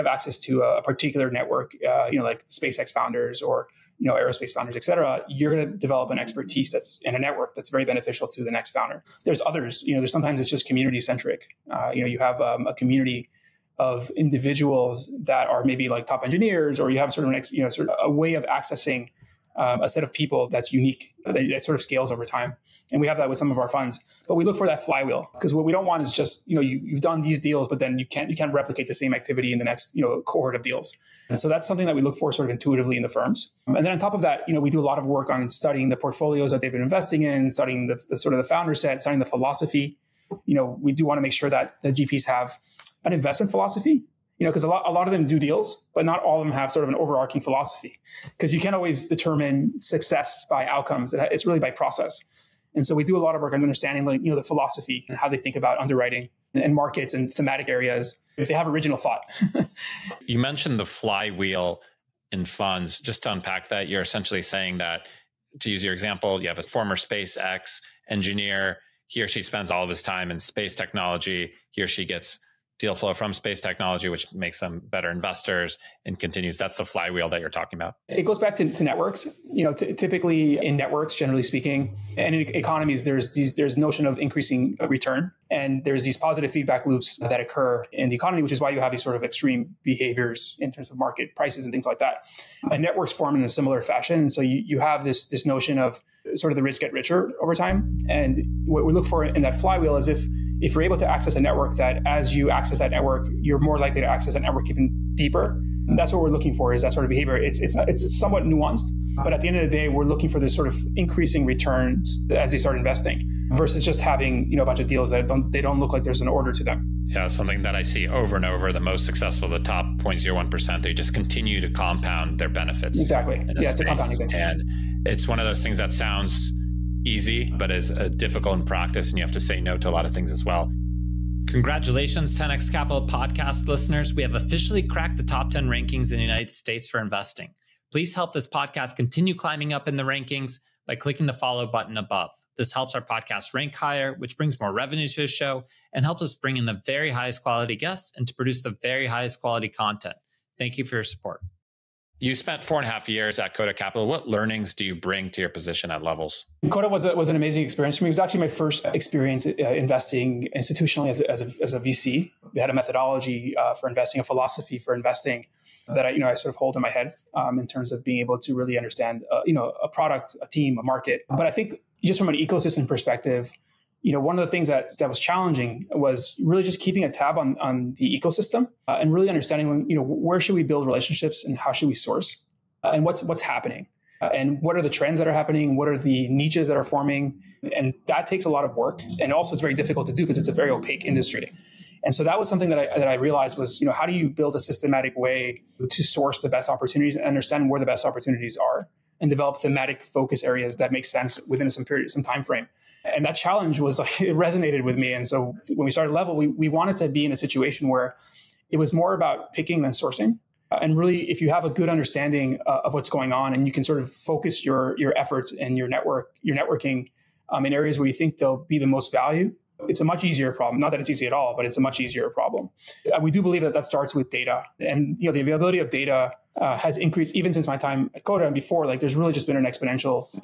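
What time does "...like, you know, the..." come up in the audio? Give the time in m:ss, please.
0:54.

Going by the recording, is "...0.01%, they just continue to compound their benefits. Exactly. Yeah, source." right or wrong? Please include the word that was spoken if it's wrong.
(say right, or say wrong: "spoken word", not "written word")
wrong: "space", not "source".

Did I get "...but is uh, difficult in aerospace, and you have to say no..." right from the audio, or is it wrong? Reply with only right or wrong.
wrong.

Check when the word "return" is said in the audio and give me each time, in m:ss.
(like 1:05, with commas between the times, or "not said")
1:24, 1:51.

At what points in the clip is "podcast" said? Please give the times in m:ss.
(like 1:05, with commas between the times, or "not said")
2:13, 2:18, 2:23.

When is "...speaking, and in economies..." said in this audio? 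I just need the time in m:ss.
1:21.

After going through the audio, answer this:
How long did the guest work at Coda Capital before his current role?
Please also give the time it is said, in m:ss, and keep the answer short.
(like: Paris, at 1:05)
four and a half years, at 2:32.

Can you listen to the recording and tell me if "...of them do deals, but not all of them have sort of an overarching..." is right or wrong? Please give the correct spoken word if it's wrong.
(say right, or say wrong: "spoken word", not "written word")
right.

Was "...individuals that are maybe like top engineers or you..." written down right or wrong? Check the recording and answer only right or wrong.
right.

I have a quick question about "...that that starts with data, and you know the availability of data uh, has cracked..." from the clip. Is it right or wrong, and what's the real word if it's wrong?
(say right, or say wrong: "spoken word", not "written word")
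wrong: "increased", not "cracked".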